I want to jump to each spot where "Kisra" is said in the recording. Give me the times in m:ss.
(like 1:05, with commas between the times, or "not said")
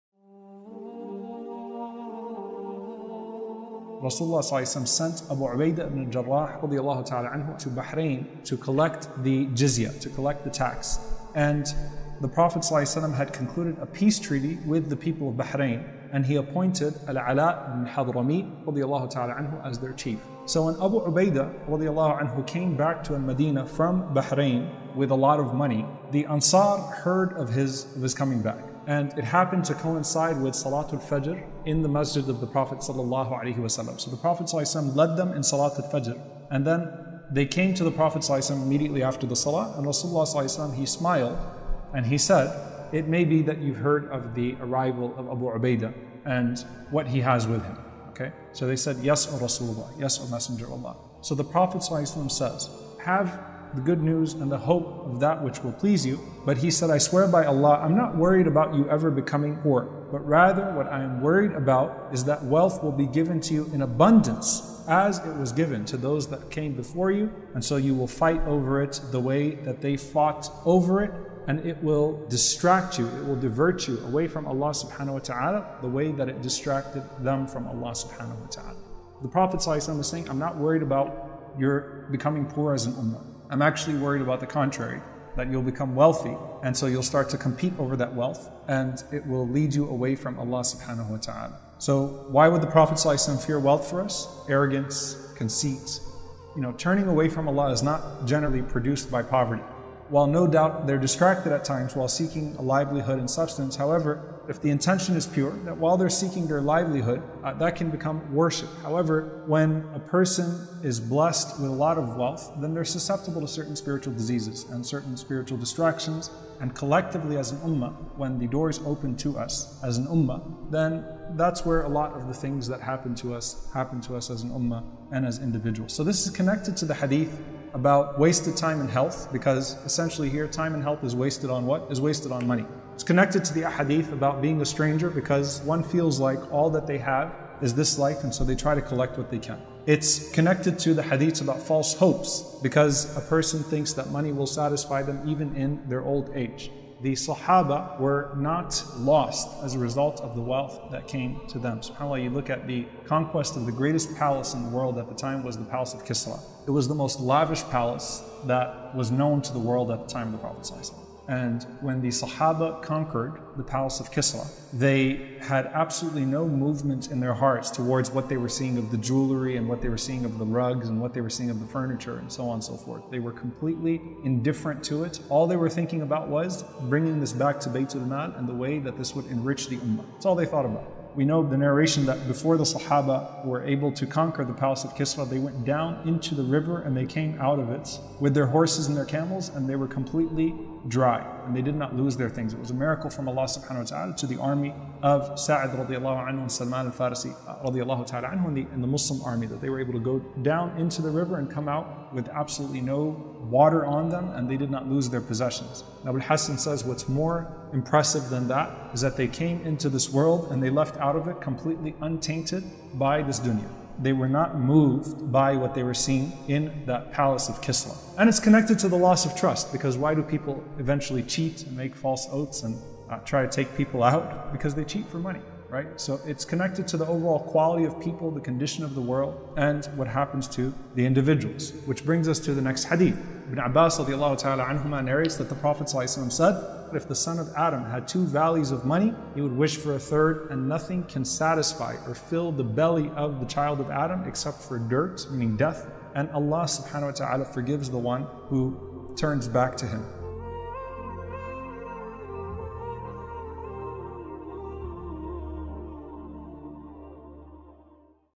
2:36, 2:44, 3:04, 3:37.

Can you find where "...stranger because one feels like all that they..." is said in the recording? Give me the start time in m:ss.
2:14.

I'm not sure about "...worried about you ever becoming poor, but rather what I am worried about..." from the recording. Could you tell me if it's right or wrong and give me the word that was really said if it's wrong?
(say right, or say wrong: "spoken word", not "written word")
right.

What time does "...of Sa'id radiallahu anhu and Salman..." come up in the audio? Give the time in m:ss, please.
3:15.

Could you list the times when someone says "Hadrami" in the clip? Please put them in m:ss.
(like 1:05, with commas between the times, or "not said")
0:17.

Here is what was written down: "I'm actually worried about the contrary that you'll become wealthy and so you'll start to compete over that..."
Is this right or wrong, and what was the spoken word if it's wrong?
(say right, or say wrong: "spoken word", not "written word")
right.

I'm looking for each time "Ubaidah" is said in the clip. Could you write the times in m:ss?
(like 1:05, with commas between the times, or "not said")
0:05, 0:21, 0:45.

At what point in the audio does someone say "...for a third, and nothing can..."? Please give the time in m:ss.
3:59.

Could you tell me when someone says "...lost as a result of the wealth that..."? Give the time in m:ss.
2:28.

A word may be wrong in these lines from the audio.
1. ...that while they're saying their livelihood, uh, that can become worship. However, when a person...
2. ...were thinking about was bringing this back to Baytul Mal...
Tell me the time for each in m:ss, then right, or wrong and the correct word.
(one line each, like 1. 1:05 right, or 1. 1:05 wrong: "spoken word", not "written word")
1. 1:45 wrong: "seeking", not "saying"
2. 2:55 right.